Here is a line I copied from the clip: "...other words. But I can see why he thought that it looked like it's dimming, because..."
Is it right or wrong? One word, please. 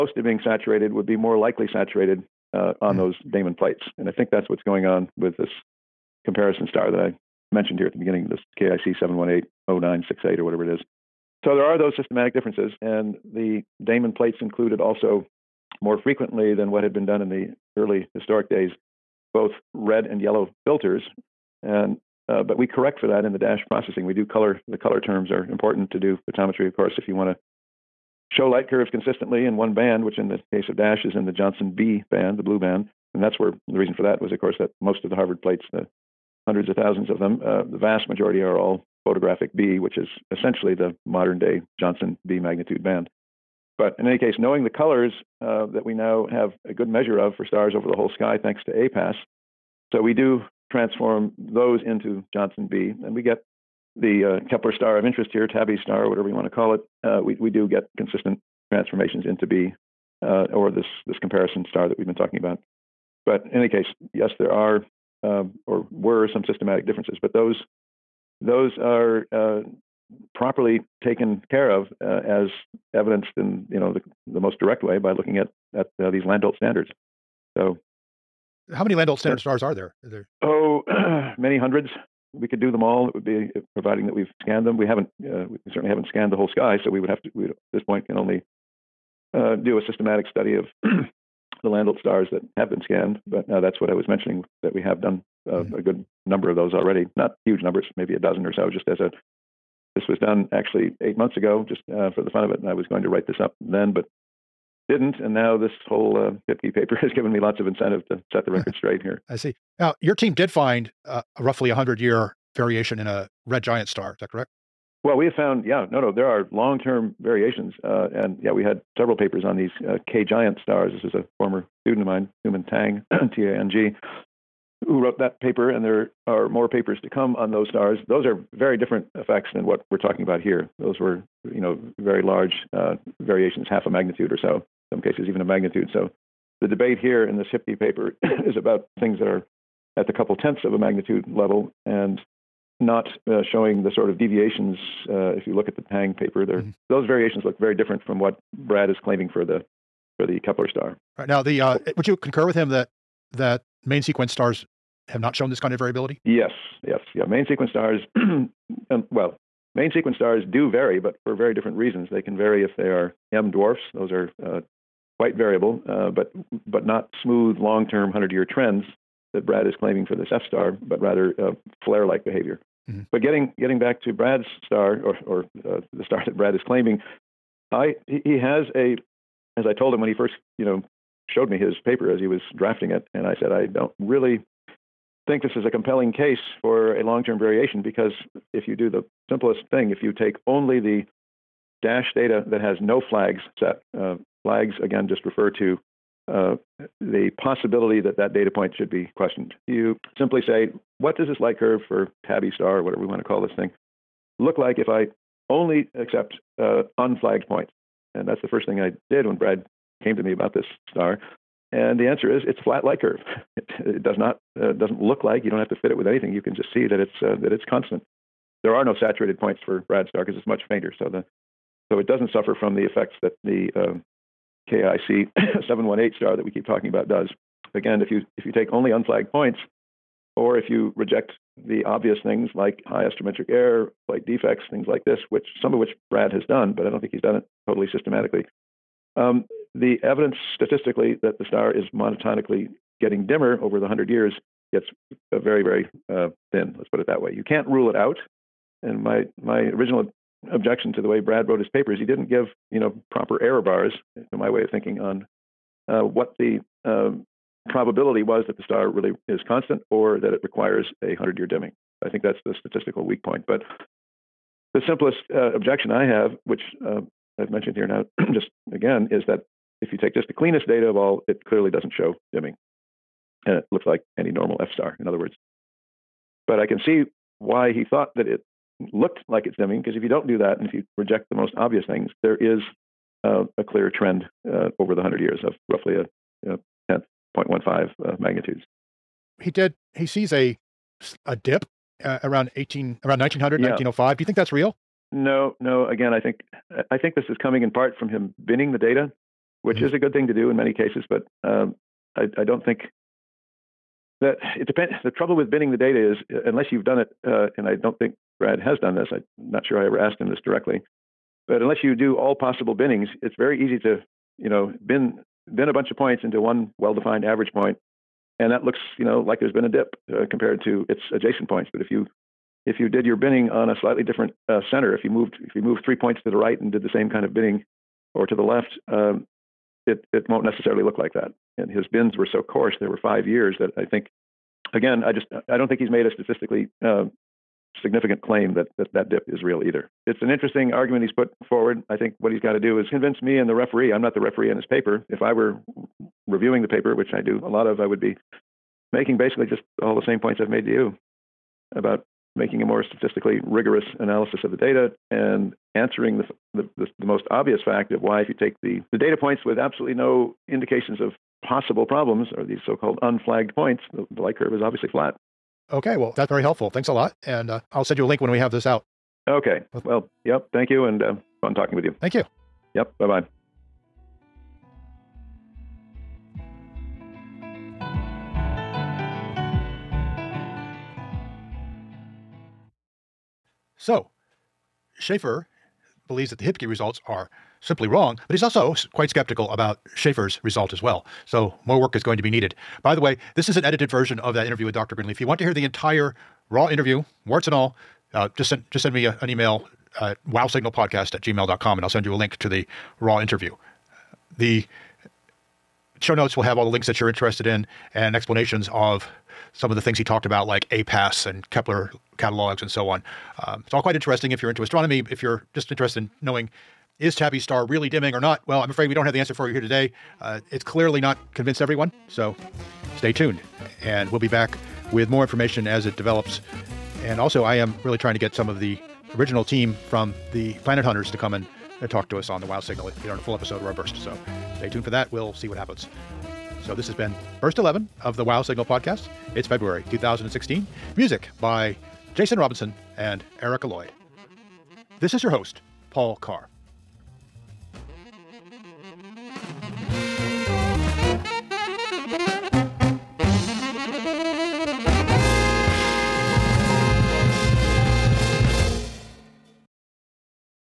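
right.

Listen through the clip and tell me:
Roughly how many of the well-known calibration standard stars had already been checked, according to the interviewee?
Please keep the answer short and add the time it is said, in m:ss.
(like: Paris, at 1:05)
a dozen, at 1:37.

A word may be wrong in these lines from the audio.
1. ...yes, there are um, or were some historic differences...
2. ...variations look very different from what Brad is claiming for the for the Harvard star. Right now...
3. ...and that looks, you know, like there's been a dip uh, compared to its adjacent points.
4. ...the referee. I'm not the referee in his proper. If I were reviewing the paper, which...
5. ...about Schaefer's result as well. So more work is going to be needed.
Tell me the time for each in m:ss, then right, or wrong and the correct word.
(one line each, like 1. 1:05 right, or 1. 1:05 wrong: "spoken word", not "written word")
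1. 1:04 wrong: "systematic", not "historic"
2. 2:27 wrong: "Kepler", not "Harvard"
3. 5:18 right
4. 5:43 wrong: "paper", not "proper"
5. 6:29 right.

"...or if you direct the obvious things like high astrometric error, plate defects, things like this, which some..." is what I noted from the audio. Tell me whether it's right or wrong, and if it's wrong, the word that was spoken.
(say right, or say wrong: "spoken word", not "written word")
wrong: "reject", not "direct".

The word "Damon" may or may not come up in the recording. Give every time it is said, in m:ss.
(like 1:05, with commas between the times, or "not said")
0:03, 0:13.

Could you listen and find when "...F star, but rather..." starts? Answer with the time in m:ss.
2:50.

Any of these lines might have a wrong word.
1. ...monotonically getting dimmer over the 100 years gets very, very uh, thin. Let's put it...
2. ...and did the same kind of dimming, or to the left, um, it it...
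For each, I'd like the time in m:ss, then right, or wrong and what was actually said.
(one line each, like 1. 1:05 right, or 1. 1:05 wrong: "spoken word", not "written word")
1. 4:01 right
2. 5:26 wrong: "binning", not "dimming".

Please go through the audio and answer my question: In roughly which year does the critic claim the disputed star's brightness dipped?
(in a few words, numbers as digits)
1905.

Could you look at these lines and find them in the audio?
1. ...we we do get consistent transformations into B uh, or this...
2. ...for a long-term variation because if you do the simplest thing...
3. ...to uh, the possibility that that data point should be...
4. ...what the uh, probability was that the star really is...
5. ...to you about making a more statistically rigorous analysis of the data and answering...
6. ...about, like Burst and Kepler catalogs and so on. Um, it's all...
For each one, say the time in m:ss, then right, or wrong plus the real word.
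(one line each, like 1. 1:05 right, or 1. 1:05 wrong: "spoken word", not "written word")
1. 0:57 right
2. 3:06 right
3. 3:15 right
4. 4:16 right
5. 5:50 right
6. 6:50 wrong: "APASS", not "Burst".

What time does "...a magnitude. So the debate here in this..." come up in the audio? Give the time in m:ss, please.
2:15.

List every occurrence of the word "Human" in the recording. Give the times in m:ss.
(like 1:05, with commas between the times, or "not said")
2:02.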